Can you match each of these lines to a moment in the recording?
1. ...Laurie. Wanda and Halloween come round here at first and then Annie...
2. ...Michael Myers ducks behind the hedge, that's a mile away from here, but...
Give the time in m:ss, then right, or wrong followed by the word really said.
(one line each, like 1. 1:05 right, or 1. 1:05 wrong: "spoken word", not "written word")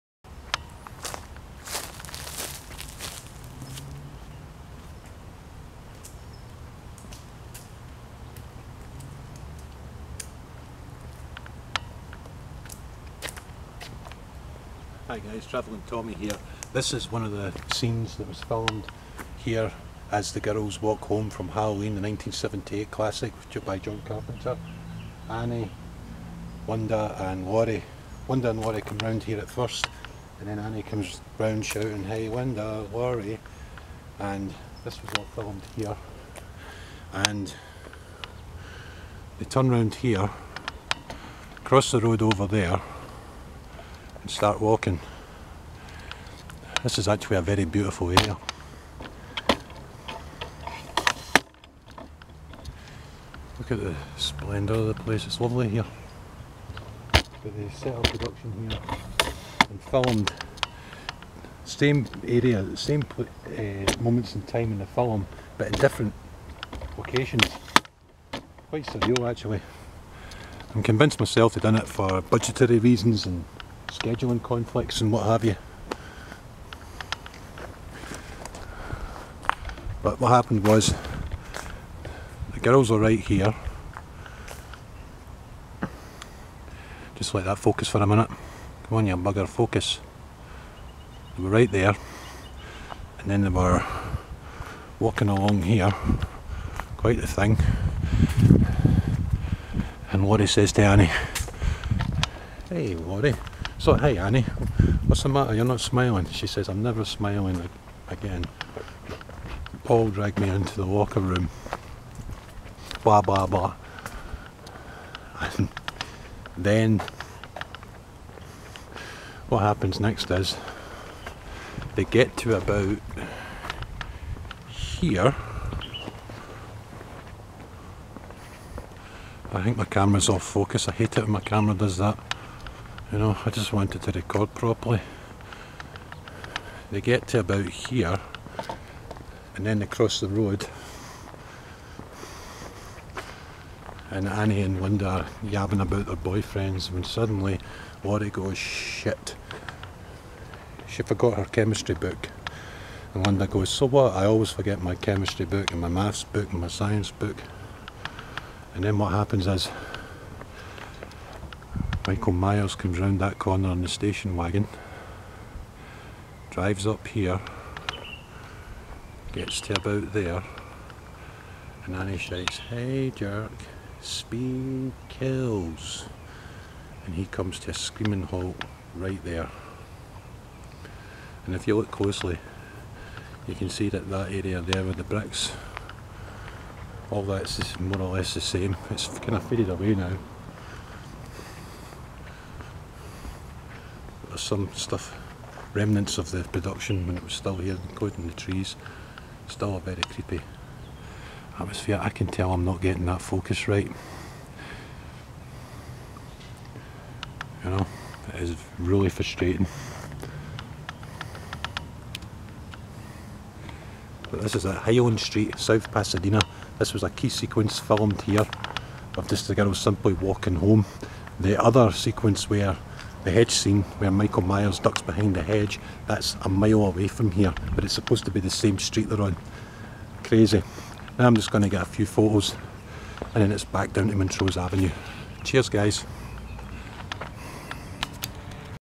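1. 0:27 wrong: "Laurie", not "Halloween"
2. 3:44 right.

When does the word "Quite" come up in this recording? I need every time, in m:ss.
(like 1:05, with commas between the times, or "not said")
1:08, 1:36.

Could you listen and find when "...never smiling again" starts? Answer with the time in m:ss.
1:46.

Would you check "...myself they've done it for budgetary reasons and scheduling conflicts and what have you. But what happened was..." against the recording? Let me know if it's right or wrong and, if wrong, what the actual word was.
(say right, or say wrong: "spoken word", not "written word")
right.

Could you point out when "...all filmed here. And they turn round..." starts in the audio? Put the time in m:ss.
0:35.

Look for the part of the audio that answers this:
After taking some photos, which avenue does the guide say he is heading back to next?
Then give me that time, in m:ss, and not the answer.
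3:54.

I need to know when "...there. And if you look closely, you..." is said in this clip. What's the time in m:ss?
2:59.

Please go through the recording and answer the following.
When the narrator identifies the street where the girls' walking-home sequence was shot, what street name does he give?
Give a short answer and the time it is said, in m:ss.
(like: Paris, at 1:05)
Highland Street, at 3:34.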